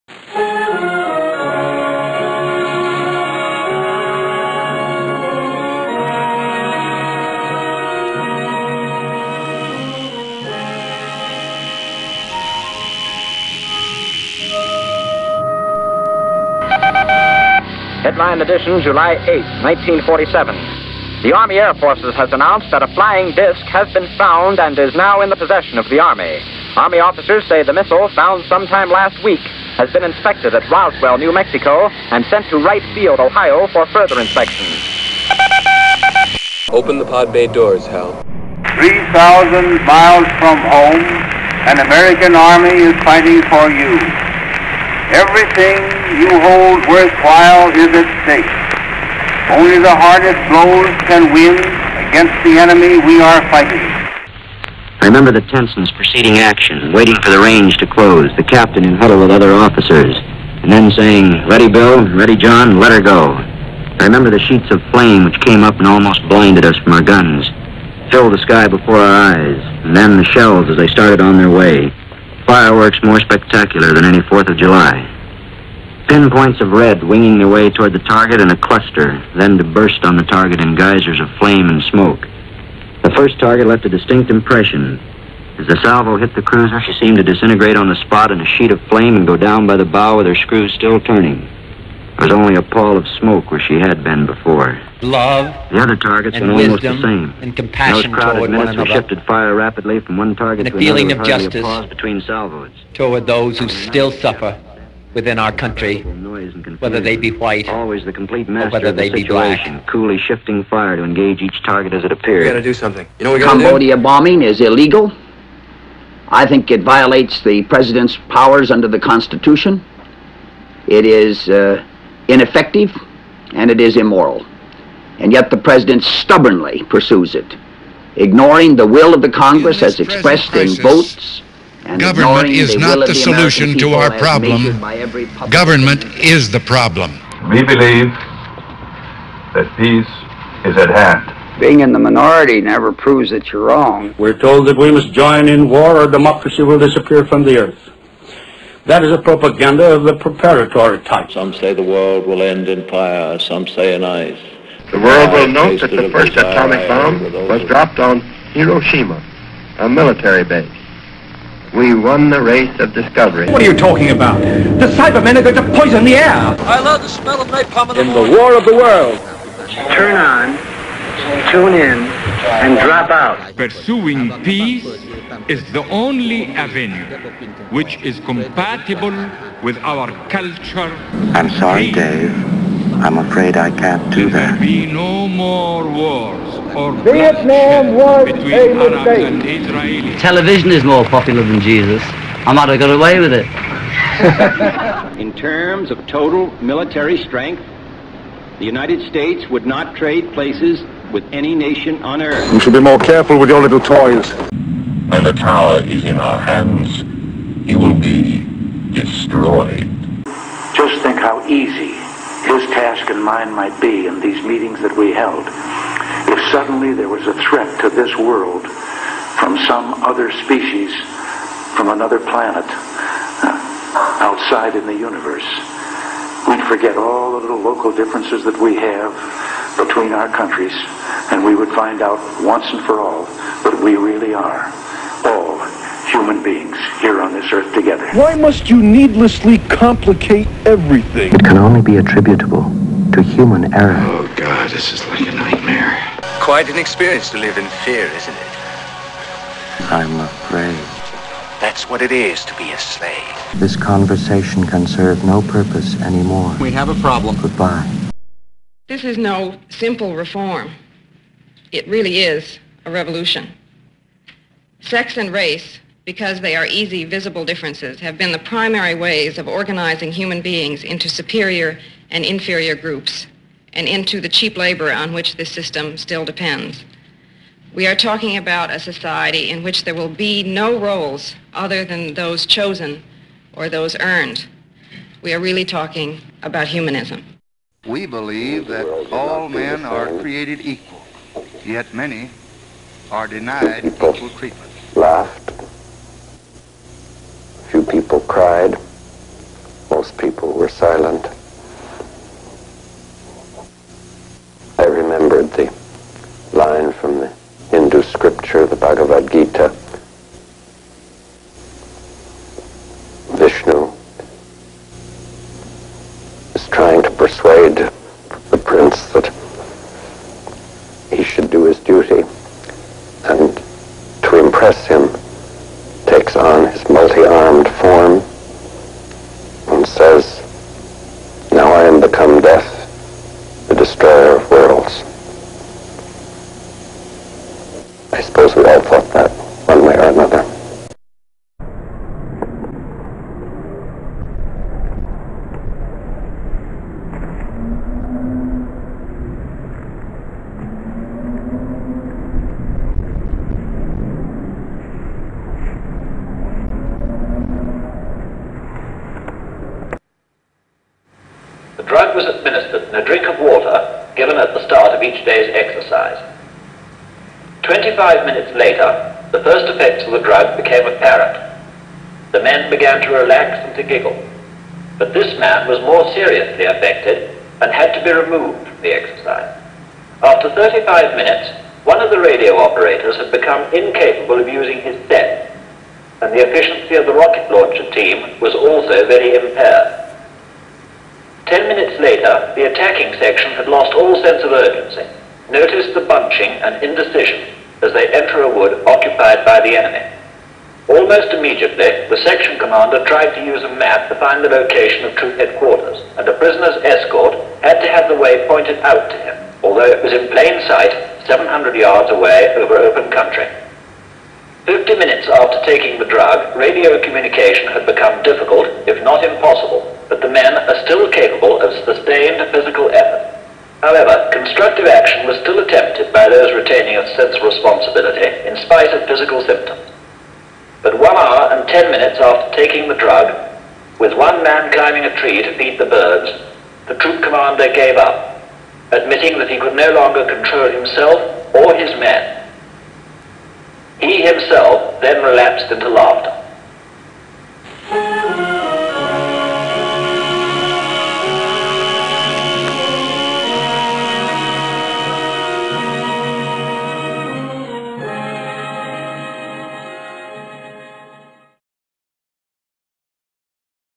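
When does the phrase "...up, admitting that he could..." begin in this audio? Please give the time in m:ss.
7:17.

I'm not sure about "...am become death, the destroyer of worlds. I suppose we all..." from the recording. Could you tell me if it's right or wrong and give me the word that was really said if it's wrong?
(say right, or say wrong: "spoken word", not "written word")
right.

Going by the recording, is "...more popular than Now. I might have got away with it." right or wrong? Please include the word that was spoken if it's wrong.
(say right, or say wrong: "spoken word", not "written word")
wrong: "Jesus", not "Now".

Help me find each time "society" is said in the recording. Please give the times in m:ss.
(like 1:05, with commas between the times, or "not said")
4:38.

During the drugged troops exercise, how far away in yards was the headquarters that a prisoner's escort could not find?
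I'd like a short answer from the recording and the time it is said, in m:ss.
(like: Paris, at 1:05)
700 yards, at 6:51.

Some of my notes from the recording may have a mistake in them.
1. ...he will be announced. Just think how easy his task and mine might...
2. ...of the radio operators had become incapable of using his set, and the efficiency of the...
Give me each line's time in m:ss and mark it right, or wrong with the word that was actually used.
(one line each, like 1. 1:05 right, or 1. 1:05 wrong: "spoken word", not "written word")
1. 3:27 wrong: "destroyed", not "announced"
2. 6:22 right.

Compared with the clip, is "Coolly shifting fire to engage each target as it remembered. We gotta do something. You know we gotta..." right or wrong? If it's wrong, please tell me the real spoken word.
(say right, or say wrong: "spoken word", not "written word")
wrong: "appeared", not "remembered".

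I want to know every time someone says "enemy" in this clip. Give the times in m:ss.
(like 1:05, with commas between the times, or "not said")
0:52, 6:39.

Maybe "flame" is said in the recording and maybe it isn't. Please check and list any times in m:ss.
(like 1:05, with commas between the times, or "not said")
1:04, 1:21, 1:28.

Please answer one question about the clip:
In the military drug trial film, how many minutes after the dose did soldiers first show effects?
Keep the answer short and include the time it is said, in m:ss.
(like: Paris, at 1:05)
25, at 6:07.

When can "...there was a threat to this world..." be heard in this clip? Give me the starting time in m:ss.
3:36.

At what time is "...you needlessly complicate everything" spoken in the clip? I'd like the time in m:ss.
3:58.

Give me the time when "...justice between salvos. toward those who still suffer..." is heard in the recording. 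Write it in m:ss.
1:41.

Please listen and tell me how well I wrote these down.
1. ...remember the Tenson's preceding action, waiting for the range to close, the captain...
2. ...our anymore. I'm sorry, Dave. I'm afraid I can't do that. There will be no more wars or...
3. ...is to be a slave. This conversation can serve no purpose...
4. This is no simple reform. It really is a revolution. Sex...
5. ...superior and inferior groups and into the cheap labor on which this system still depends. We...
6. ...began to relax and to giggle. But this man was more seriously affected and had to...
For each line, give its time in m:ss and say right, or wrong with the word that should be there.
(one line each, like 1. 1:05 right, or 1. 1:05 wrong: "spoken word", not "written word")
1. 0:55 right
2. 2:59 wrong: "culture", not "anymore"
3. 4:12 right
4. 4:18 right
5. 4:31 right
6. 6:12 right.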